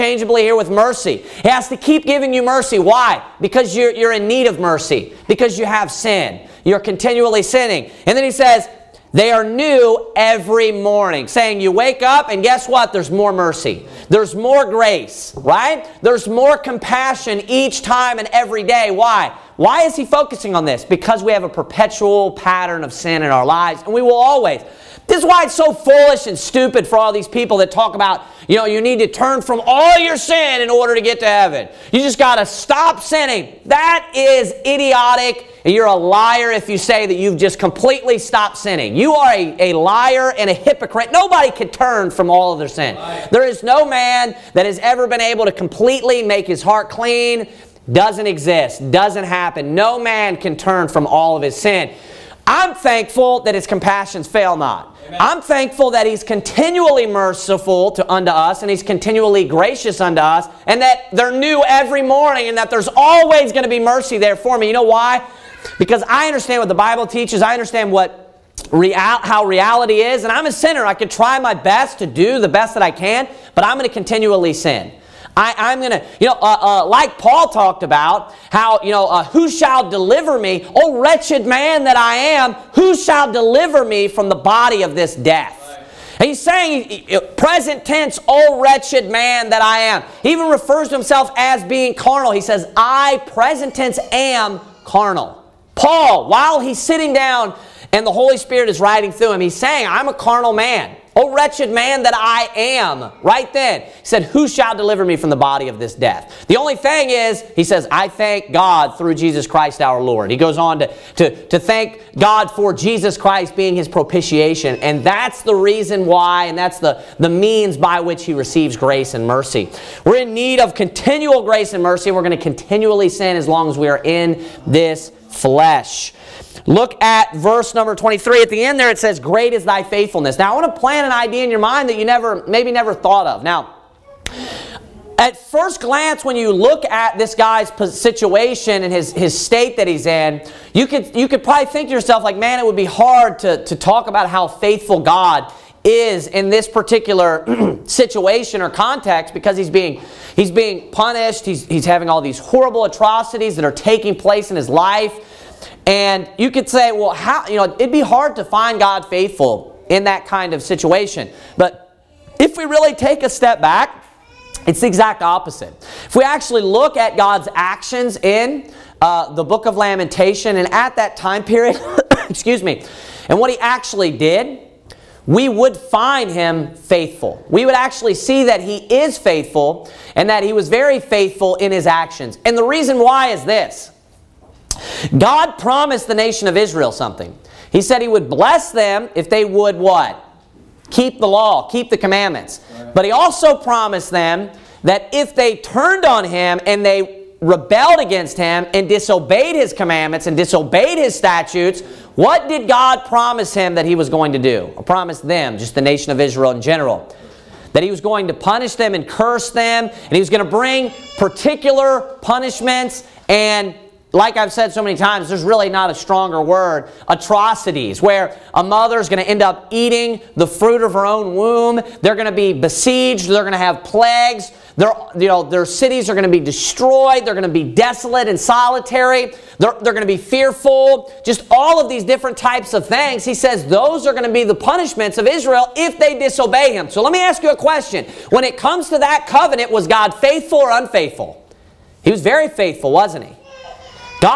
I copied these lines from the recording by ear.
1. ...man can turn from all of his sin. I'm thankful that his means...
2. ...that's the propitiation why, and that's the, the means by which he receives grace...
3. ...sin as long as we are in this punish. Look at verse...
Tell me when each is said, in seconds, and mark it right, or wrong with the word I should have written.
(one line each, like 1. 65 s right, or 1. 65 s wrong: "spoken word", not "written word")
1. 50 s wrong: "compassions", not "means"
2. 115 s wrong: "reason", not "propitiation"
3. 123 s wrong: "flesh", not "punish".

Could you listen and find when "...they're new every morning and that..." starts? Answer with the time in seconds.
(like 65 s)
61 s.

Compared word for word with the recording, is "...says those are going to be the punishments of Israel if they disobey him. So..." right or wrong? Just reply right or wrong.
right.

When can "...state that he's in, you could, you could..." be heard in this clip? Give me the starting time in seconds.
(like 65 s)
139 s.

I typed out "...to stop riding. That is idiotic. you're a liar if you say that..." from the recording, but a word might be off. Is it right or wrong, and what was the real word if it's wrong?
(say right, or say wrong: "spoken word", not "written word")
wrong: "sinning", not "riding".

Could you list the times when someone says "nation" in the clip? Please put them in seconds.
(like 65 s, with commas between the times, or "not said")
186 s, 205 s.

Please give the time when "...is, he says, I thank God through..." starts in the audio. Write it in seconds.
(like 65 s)
107 s.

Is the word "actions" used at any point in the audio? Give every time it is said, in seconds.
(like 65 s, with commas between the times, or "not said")
167 s, 181 s.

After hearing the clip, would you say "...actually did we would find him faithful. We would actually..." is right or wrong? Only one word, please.
right.